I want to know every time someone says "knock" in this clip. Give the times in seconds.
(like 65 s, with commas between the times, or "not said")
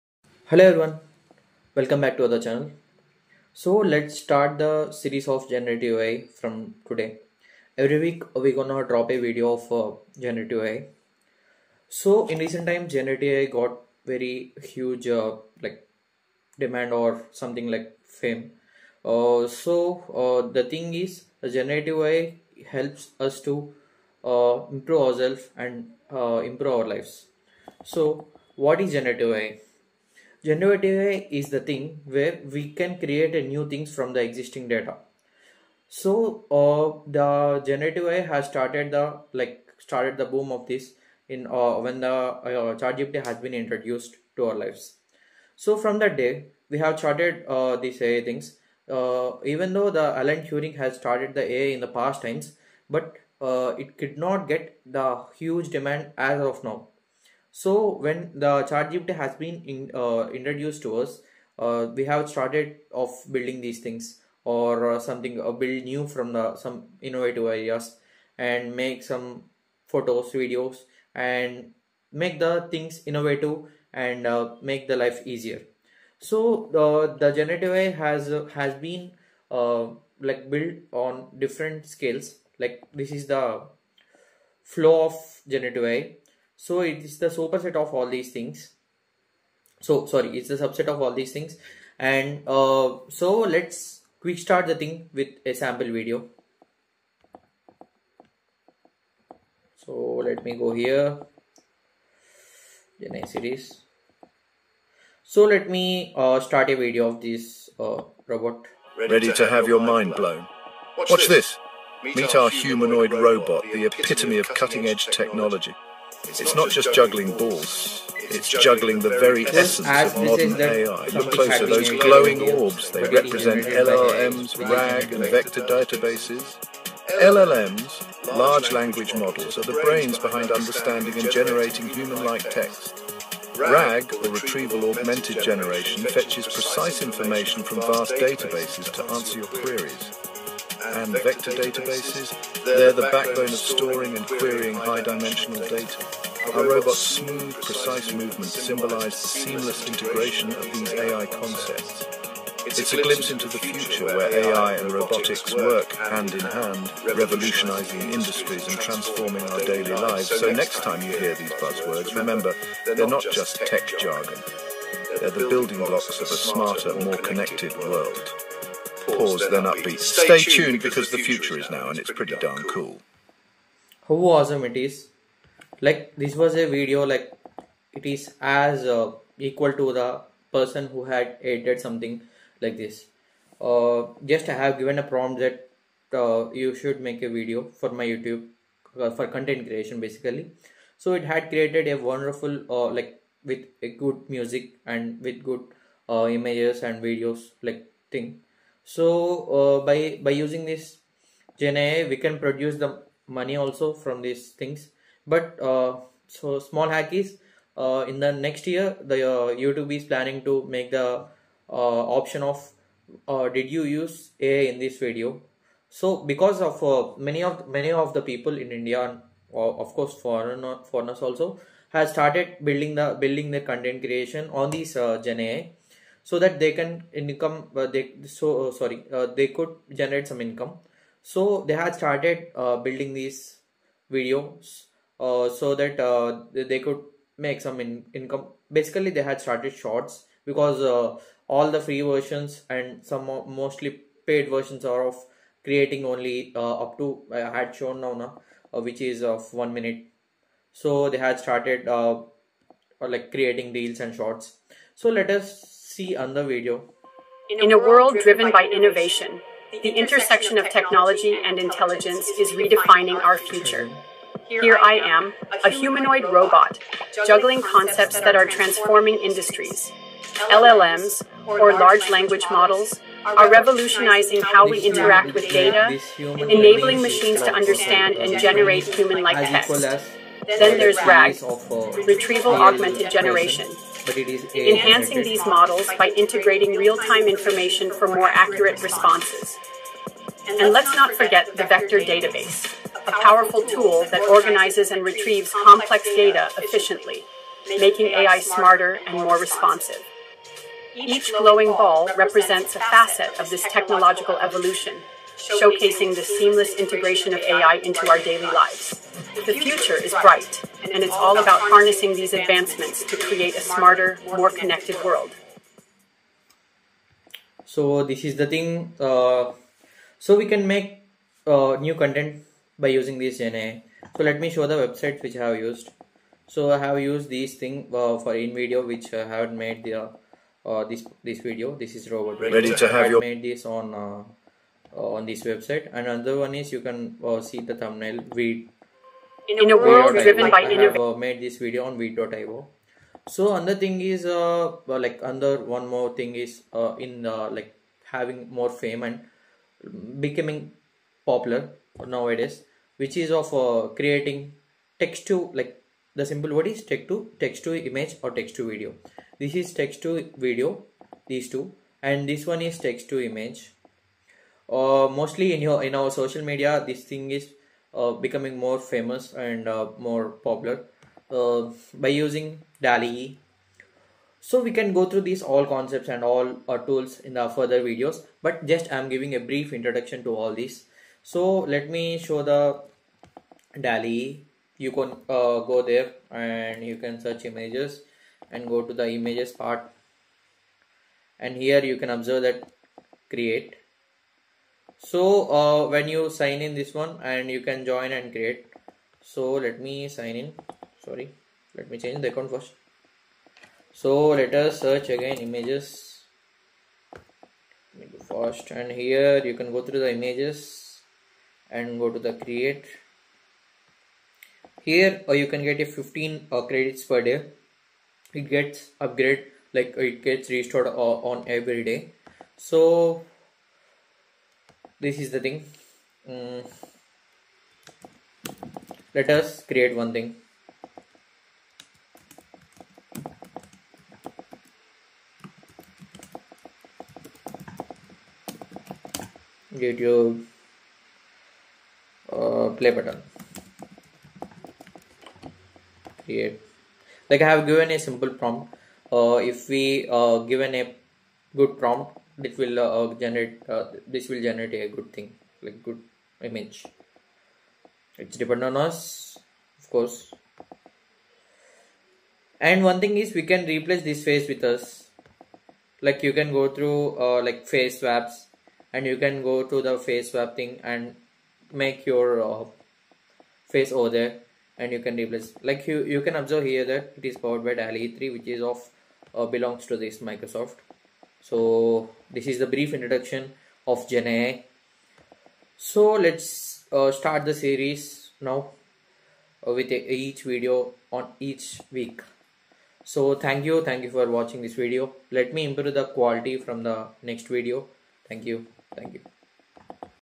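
not said.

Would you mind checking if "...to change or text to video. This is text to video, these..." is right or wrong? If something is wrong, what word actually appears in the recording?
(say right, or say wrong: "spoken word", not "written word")
wrong: "image", not "change".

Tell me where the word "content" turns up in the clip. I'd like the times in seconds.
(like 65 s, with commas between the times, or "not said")
189 s, 223 s, 321 s.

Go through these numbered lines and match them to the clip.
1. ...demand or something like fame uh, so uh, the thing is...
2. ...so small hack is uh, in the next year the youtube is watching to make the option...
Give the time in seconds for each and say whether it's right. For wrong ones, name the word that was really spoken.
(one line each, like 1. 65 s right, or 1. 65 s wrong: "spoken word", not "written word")
1. 16 s right
2. 206 s wrong: "planning", not "watching".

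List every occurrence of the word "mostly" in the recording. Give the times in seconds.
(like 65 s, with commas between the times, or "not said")
243 s, 365 s.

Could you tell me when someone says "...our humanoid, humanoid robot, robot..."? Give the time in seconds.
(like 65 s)
112 s.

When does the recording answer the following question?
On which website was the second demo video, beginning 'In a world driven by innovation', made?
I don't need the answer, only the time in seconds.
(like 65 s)
341 s.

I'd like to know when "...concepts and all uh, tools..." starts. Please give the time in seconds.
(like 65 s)
375 s.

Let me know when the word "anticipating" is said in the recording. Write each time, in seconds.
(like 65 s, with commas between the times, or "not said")
not said.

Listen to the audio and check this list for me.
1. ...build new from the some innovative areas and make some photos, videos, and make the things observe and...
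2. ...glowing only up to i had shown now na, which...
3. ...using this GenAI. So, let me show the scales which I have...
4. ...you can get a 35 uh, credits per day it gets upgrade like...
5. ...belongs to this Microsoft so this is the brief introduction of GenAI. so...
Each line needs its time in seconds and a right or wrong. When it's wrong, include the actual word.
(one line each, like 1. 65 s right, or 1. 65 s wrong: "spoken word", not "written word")
1. 65 s wrong: "innovative", not "observe"
2. 245 s wrong: "creating", not "glowing"
3. 322 s wrong: "websites", not "scales"
4. 415 s wrong: "15", not "35"
5. 479 s right.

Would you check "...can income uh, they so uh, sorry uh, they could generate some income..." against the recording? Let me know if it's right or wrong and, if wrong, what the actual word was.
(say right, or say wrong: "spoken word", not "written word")
right.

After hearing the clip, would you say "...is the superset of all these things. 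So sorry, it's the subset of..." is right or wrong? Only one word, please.
right.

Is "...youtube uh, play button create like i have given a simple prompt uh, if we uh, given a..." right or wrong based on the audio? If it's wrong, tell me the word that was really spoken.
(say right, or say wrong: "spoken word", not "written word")
right.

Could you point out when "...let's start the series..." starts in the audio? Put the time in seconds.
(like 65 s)
3 s.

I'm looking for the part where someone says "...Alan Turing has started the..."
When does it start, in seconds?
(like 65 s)
50 s.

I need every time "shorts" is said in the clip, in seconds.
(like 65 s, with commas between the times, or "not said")
239 s, 254 s.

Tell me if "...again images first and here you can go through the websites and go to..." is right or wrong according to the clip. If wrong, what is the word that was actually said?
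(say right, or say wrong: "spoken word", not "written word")
wrong: "images", not "websites".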